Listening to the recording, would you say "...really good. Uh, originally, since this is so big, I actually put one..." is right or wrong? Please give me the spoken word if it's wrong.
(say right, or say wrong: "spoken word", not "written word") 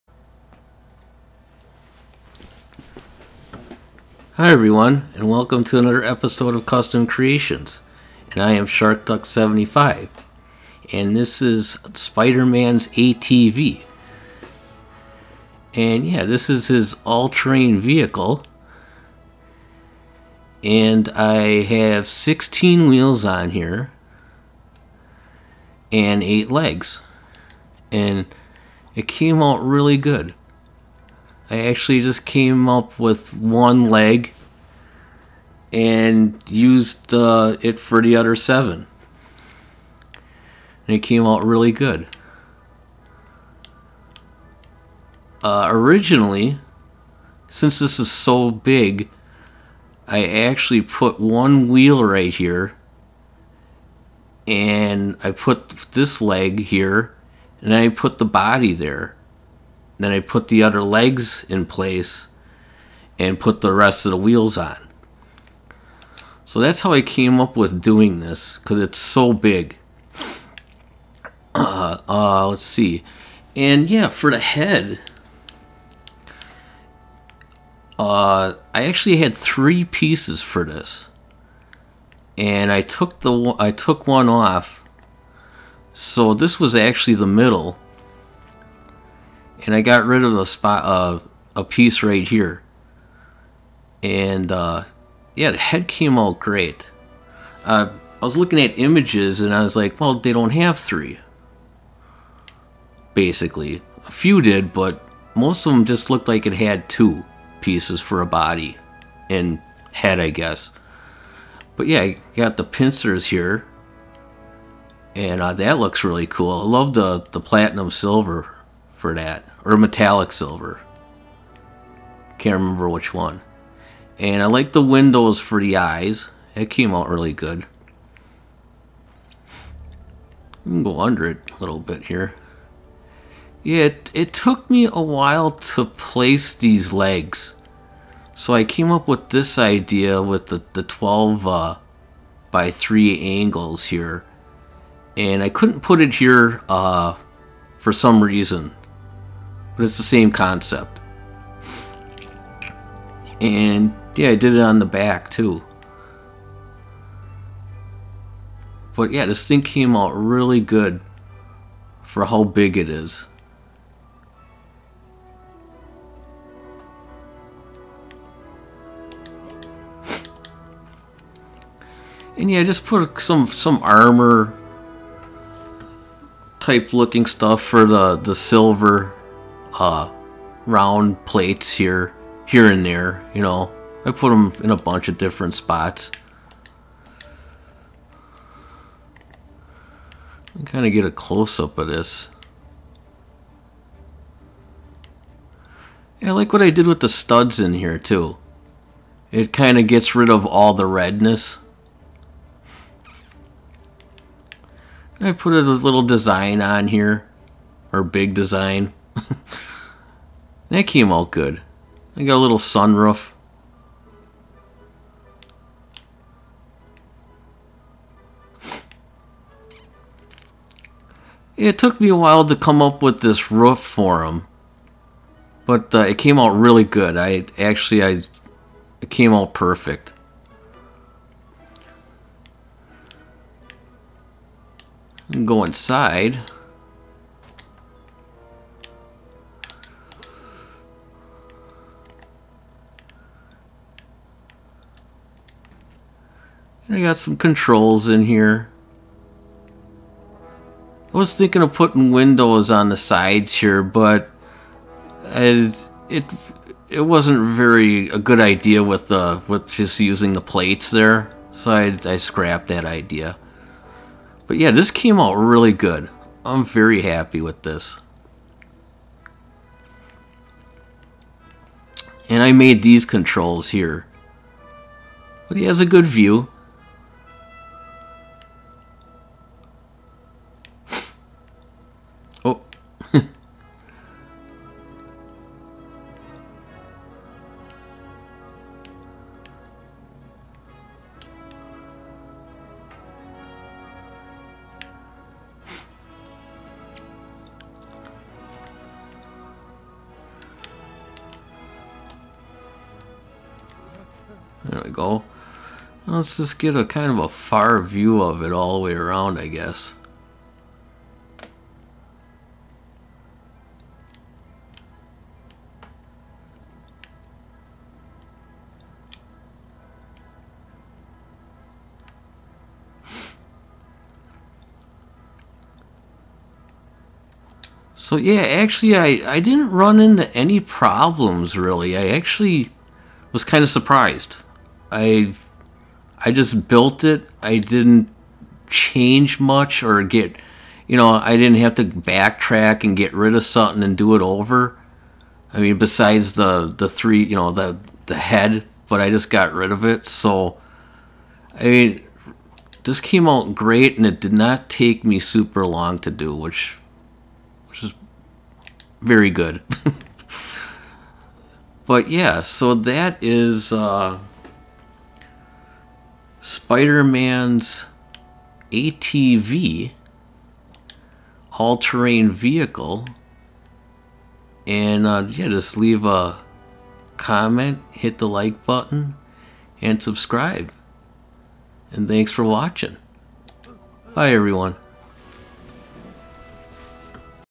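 right.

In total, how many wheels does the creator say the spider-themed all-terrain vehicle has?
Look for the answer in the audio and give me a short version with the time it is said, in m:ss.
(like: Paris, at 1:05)
16, at 0:22.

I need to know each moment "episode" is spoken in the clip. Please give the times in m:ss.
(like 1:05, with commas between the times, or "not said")
0:06.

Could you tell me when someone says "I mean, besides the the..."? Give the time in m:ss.
5:45.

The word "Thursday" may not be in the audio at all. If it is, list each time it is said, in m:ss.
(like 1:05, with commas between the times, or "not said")
not said.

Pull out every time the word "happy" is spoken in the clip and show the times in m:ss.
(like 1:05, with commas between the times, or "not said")
4:27.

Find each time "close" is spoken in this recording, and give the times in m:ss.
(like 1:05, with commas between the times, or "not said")
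3:11.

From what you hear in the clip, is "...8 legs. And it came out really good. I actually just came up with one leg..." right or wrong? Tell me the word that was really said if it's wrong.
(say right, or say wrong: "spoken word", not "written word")
right.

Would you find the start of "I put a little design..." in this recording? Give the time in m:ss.
3:25.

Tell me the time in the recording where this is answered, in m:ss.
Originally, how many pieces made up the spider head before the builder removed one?
1:19.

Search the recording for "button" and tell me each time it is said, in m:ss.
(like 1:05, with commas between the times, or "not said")
6:18.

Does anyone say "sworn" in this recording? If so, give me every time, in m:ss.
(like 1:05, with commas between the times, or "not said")
not said.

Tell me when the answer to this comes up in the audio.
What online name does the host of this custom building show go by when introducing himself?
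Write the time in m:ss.
0:08.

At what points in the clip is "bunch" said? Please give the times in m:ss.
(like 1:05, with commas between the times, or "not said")
3:04.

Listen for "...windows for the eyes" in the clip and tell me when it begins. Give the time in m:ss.
2:04.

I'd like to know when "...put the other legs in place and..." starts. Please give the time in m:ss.
1:00.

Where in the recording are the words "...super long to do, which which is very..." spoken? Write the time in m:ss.
5:55.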